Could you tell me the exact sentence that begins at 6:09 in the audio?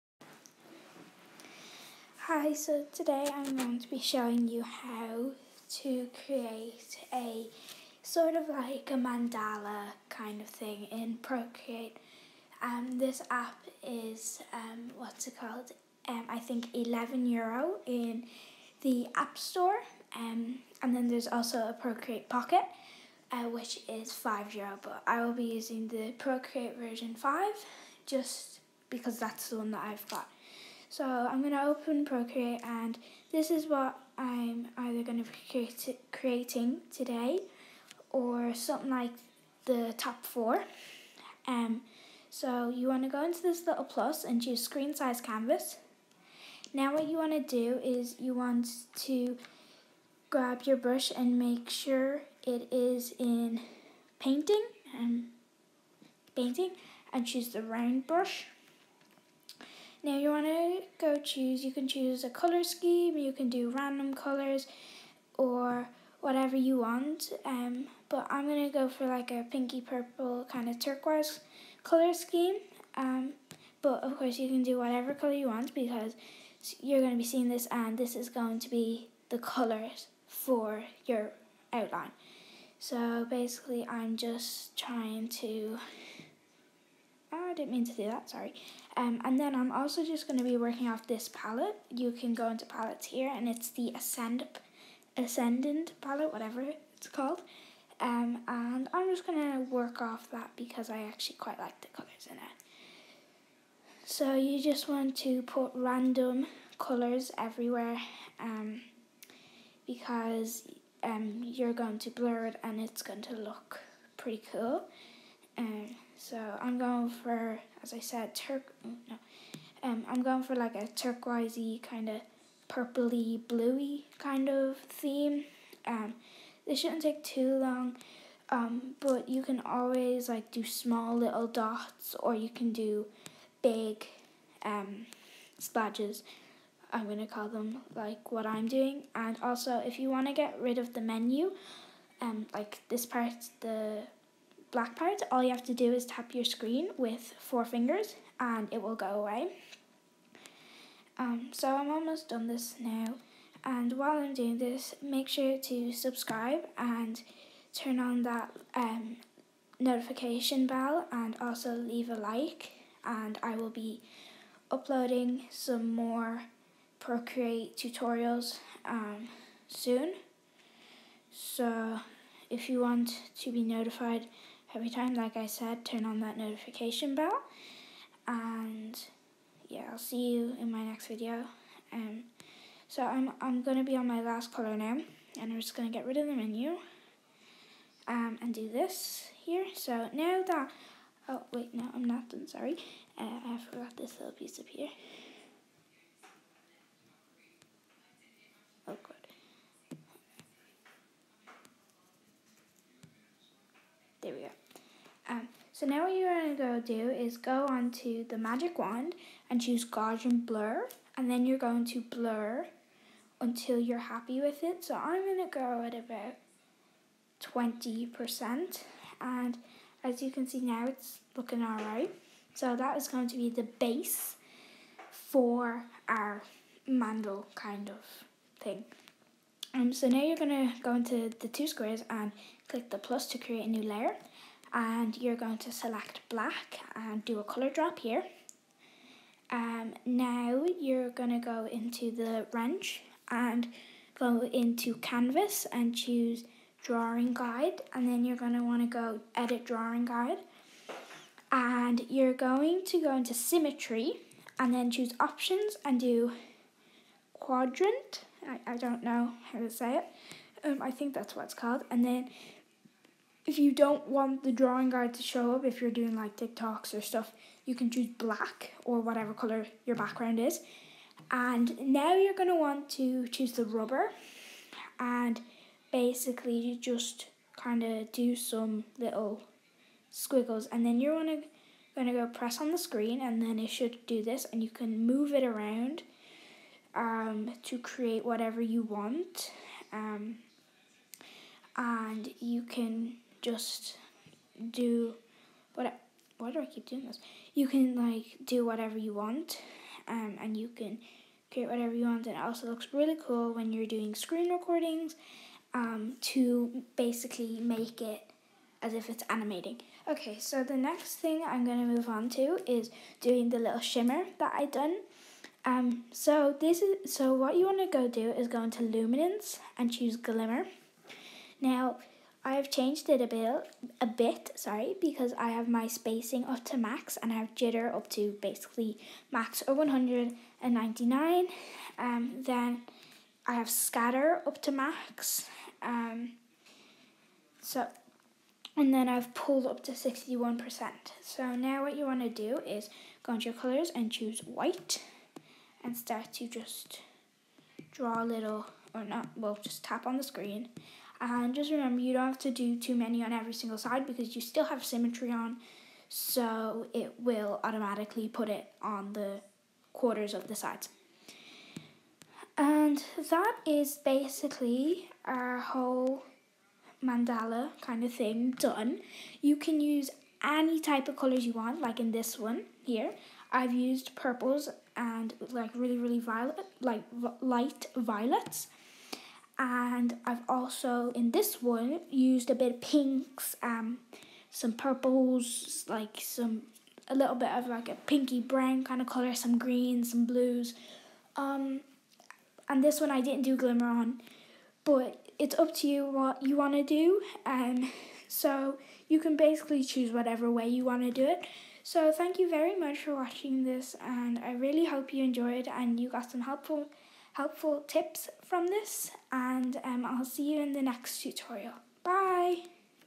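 You can use any type of colors you want, like in this one here.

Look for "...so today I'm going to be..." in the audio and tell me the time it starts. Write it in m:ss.
0:02.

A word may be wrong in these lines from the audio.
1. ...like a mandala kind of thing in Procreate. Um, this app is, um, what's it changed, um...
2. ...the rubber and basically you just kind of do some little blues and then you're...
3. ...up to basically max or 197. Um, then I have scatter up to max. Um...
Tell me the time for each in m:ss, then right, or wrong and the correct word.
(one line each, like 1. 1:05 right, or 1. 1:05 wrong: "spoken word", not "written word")
1. 0:08 wrong: "called", not "changed"
2. 4:33 wrong: "squiggles", not "blues"
3. 5:27 wrong: "199", not "197".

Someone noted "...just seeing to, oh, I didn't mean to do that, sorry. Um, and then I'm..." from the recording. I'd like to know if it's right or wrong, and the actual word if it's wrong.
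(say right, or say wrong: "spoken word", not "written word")
wrong: "trying", not "seeing".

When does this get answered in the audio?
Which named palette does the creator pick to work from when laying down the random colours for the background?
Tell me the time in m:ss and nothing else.
1:35.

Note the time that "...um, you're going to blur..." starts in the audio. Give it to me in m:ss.
1:51.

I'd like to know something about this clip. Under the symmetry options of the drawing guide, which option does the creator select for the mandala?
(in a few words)
Quadrant.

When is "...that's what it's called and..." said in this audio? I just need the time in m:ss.
4:21.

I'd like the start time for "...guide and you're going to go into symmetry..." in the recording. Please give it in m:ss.
4:10.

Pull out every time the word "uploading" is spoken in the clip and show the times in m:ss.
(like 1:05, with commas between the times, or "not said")
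2:44.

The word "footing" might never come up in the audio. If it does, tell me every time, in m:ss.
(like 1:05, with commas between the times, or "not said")
not said.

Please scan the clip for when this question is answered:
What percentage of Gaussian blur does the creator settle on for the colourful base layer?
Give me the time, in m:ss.
3:37.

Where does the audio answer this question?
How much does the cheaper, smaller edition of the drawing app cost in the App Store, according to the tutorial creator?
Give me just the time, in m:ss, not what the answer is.
0:24.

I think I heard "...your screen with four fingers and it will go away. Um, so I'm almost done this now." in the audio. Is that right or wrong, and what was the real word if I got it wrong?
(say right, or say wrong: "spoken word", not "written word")
right.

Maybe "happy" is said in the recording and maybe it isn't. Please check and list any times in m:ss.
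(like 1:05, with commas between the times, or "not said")
3:34.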